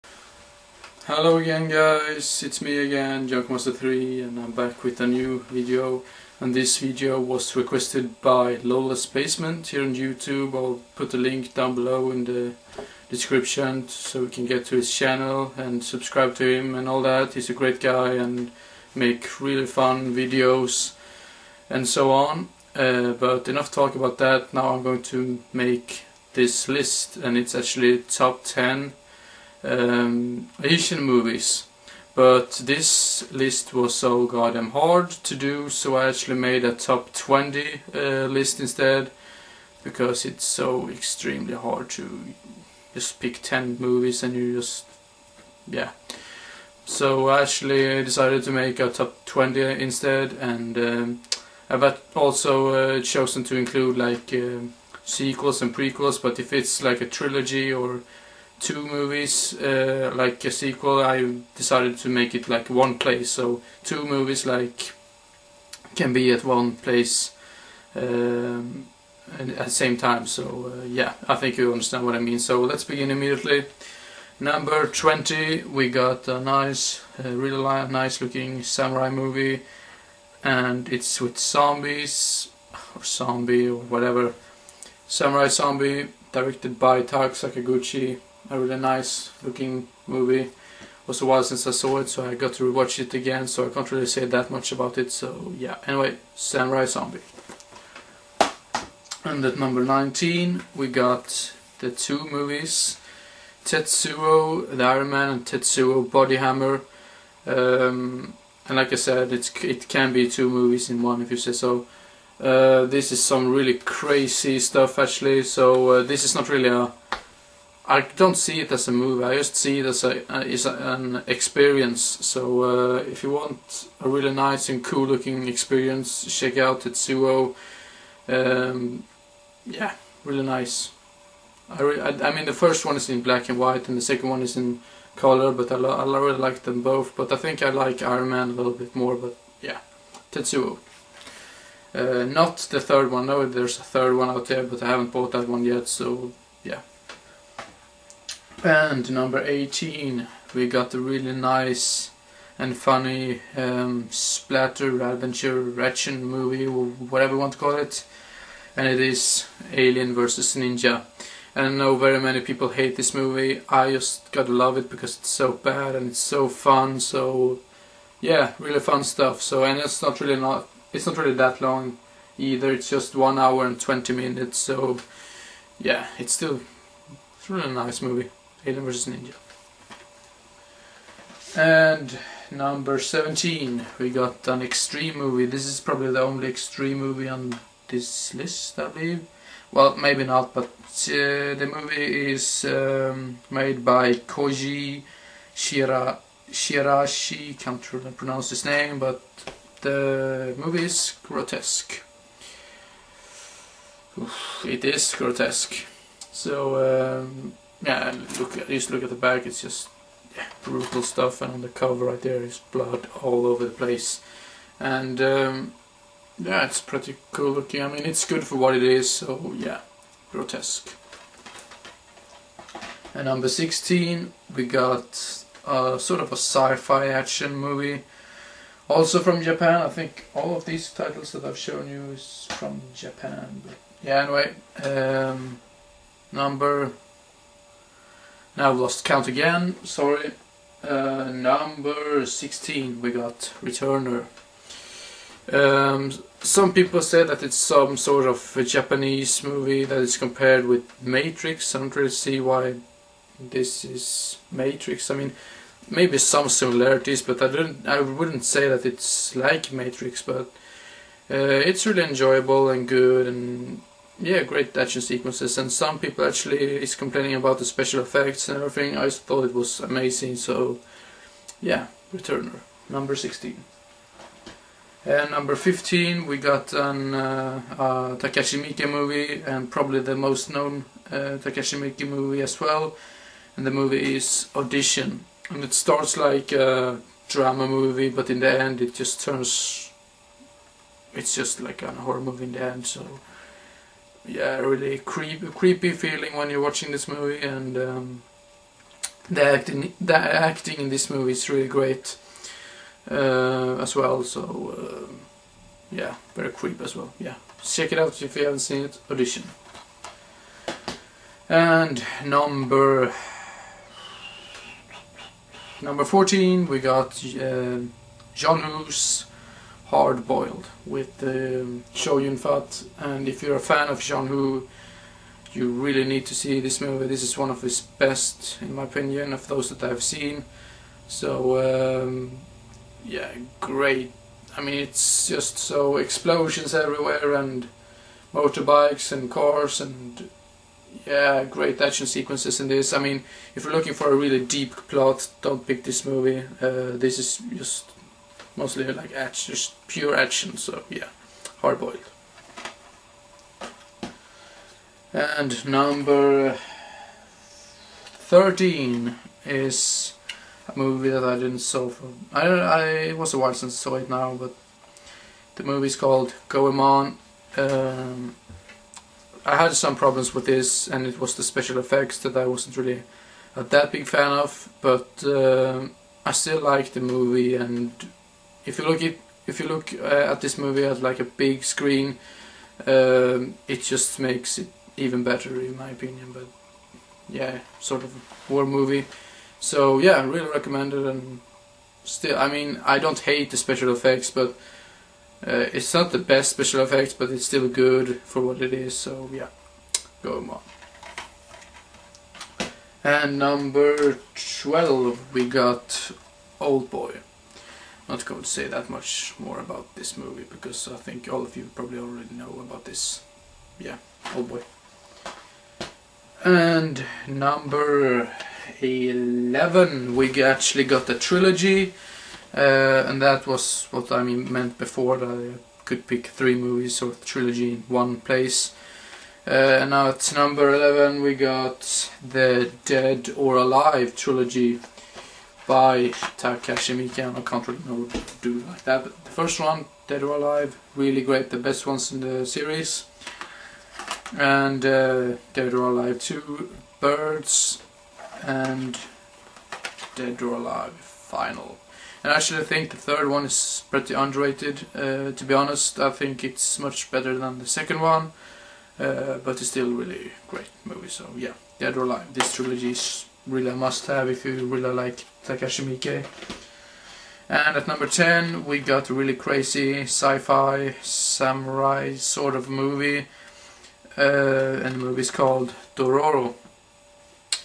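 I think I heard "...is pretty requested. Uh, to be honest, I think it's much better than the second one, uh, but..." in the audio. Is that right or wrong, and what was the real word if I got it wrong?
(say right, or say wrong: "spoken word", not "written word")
wrong: "underrated", not "requested".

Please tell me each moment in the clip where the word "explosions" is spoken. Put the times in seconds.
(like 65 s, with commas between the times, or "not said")
335 s.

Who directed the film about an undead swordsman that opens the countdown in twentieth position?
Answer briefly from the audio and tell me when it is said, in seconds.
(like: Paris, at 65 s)
Tak Sakaguchi, at 87 s.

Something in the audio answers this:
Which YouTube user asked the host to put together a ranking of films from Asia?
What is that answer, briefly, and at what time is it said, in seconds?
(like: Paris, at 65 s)
LolazBasement, at 8 s.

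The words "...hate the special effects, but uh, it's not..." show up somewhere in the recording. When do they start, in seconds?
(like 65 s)
393 s.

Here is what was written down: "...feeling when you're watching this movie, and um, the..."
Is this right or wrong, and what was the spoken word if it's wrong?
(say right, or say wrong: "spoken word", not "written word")
right.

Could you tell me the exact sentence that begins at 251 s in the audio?
I don't really see why this is Matrix.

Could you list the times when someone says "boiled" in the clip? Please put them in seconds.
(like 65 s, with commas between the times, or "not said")
320 s, 351 s.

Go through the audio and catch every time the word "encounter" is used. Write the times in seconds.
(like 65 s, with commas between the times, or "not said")
not said.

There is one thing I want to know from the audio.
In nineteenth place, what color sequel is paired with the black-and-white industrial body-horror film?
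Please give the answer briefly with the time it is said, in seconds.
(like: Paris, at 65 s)
Tetsuo Body Hammer, at 105 s.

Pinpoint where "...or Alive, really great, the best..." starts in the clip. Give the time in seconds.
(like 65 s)
440 s.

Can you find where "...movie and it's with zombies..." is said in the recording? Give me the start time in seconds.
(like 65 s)
79 s.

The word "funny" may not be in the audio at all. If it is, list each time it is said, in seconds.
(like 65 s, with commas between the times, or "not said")
152 s.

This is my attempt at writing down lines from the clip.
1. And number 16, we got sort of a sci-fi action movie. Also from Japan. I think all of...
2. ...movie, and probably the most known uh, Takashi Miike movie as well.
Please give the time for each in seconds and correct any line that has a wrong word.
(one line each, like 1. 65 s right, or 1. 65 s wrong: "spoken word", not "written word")
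1. 223 s right
2. 278 s right.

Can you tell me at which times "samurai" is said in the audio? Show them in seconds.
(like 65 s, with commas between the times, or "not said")
78 s, 85 s, 96 s, 471 s.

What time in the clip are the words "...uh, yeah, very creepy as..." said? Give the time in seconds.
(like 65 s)
305 s.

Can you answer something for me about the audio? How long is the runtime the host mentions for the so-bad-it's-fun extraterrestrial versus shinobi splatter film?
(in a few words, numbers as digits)
1 hour 20 minutes.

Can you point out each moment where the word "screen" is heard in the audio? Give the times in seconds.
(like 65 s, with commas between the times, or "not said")
381 s.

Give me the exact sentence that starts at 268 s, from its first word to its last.
I thought it was amazing, so yeah, Returner, number 16.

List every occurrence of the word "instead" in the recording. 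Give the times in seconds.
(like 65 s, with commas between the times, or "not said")
38 s, 49 s.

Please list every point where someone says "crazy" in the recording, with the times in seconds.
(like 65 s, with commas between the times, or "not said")
113 s, 469 s.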